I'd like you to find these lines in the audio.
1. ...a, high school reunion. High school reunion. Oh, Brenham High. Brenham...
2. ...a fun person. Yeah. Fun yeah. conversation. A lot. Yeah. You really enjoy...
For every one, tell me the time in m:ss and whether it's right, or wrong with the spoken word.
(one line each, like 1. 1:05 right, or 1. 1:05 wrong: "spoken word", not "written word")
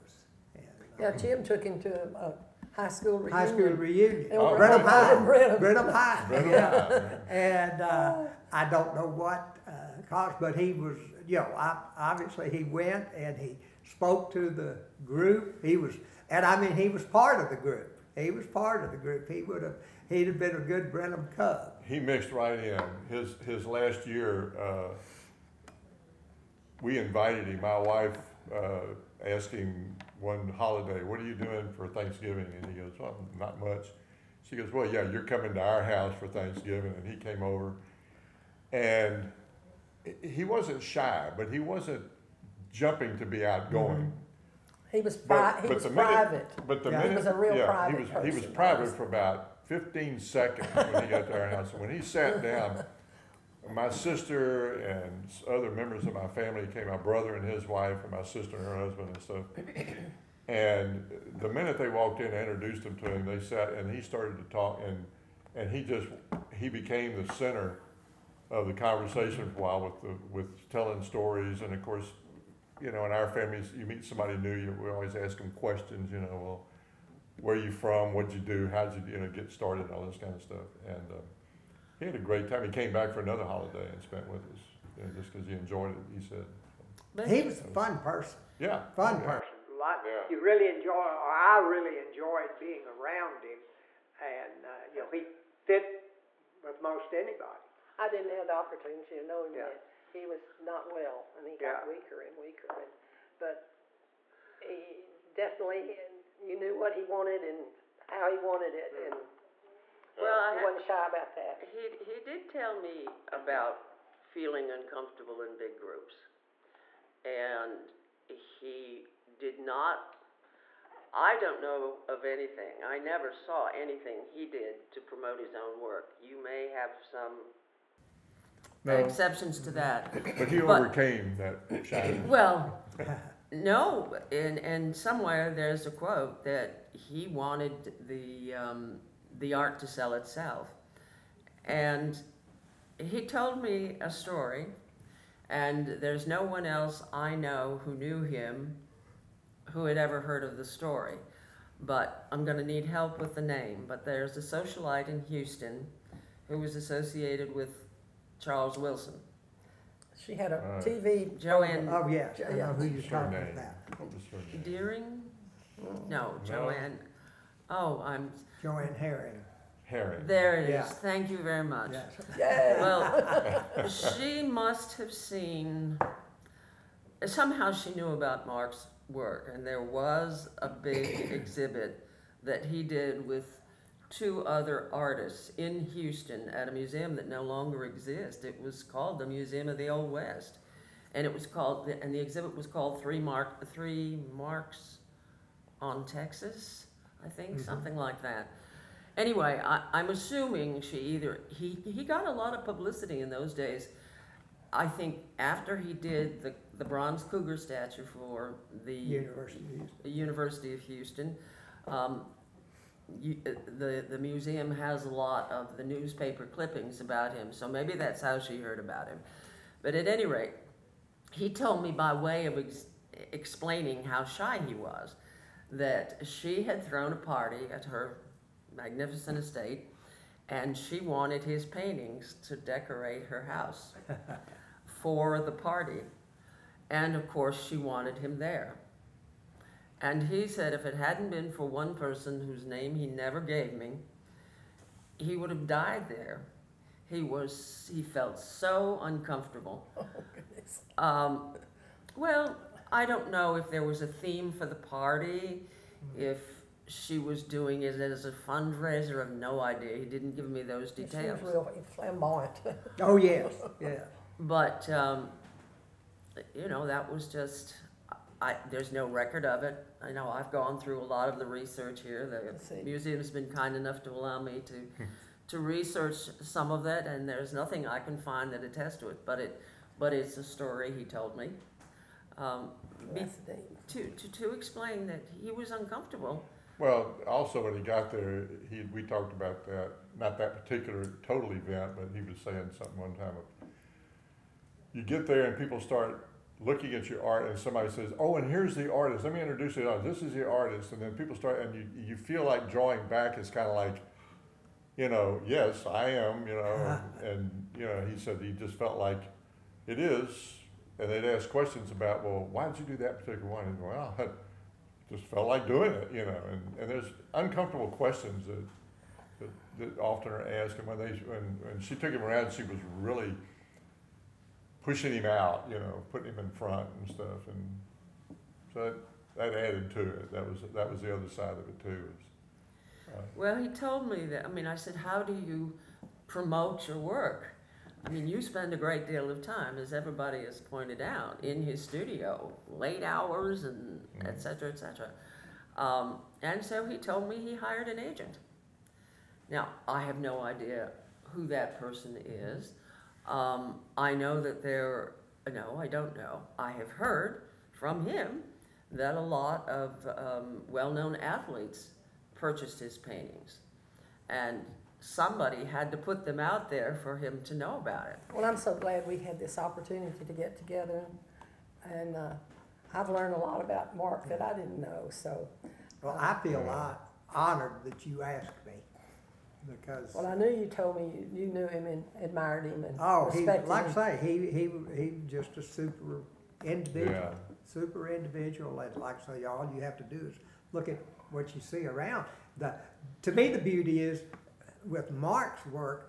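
1. 0:02 right
2. 1:27 wrong: "person", not "conversation".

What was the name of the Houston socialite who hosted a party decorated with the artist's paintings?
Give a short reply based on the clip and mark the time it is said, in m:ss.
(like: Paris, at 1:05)
Joanne Herring, at 2:48.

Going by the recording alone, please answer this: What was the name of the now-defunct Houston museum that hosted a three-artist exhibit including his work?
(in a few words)
Museum of the Old West.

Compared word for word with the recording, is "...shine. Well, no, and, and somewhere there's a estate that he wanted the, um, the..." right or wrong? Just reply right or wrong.
wrong.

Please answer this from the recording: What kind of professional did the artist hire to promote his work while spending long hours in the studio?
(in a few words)
an agent.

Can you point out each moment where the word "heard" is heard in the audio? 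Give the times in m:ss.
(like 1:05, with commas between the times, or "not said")
2:30, 3:38, 5:56.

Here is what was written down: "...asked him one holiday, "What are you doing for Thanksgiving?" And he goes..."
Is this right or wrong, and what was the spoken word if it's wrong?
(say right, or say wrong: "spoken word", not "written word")
right.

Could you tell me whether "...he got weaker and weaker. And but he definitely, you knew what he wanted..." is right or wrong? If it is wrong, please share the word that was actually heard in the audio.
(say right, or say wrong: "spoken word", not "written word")
right.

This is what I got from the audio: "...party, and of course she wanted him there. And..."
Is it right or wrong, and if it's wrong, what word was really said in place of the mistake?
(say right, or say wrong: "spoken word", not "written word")
right.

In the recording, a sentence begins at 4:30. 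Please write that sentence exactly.
I know I've gone through a lot of the research here.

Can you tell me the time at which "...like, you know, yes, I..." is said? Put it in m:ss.
5:03.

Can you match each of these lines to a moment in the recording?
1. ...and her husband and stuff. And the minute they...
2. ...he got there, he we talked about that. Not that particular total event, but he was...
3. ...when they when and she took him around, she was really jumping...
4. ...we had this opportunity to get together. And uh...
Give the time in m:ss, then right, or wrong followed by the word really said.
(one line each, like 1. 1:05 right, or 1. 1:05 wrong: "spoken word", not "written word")
1. 0:58 right
2. 4:47 right
3. 5:20 wrong: "pushing", not "jumping"
4. 6:09 right.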